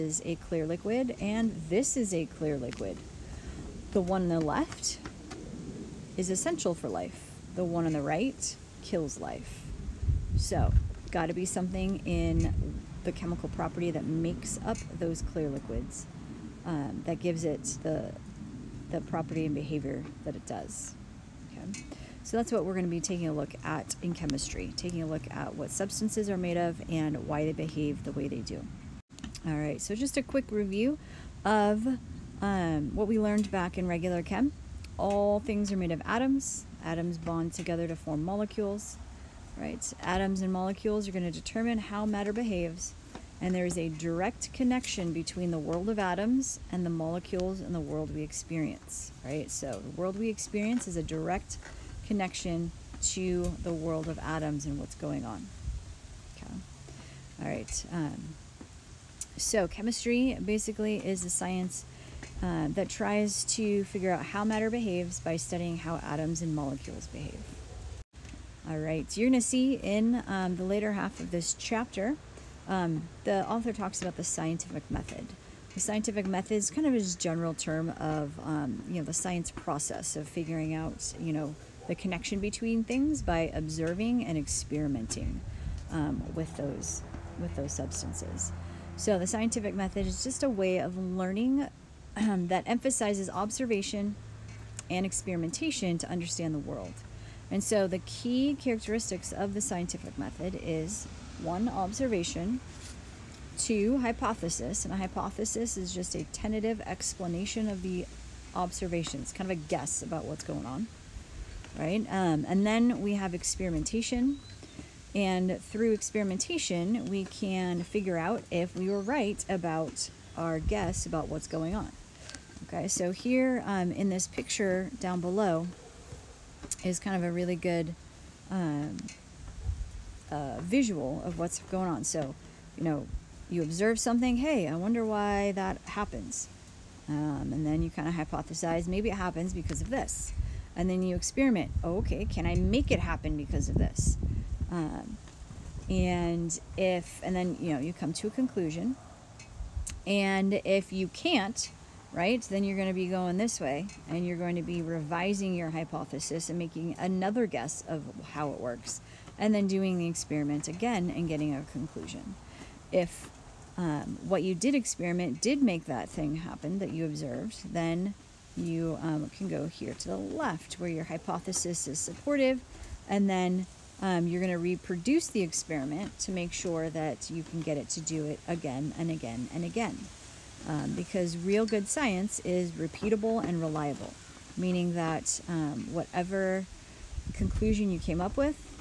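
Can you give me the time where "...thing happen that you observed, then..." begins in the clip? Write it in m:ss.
2:46.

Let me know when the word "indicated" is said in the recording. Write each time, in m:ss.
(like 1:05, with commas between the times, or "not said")
not said.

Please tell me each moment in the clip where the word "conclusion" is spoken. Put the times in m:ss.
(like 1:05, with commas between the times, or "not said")
2:28, 2:41, 3:07.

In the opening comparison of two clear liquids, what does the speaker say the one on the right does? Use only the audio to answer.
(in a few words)
Kills life.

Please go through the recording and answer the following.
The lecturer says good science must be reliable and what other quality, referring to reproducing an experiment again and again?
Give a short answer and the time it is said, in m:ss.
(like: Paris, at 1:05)
Repeatable, at 3:02.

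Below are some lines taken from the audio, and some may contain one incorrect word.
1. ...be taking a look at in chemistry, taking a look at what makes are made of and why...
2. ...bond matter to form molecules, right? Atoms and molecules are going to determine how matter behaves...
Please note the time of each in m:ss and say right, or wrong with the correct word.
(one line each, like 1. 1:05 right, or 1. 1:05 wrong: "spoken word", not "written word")
1. 0:22 wrong: "substances", not "makes"
2. 0:37 wrong: "together", not "matter".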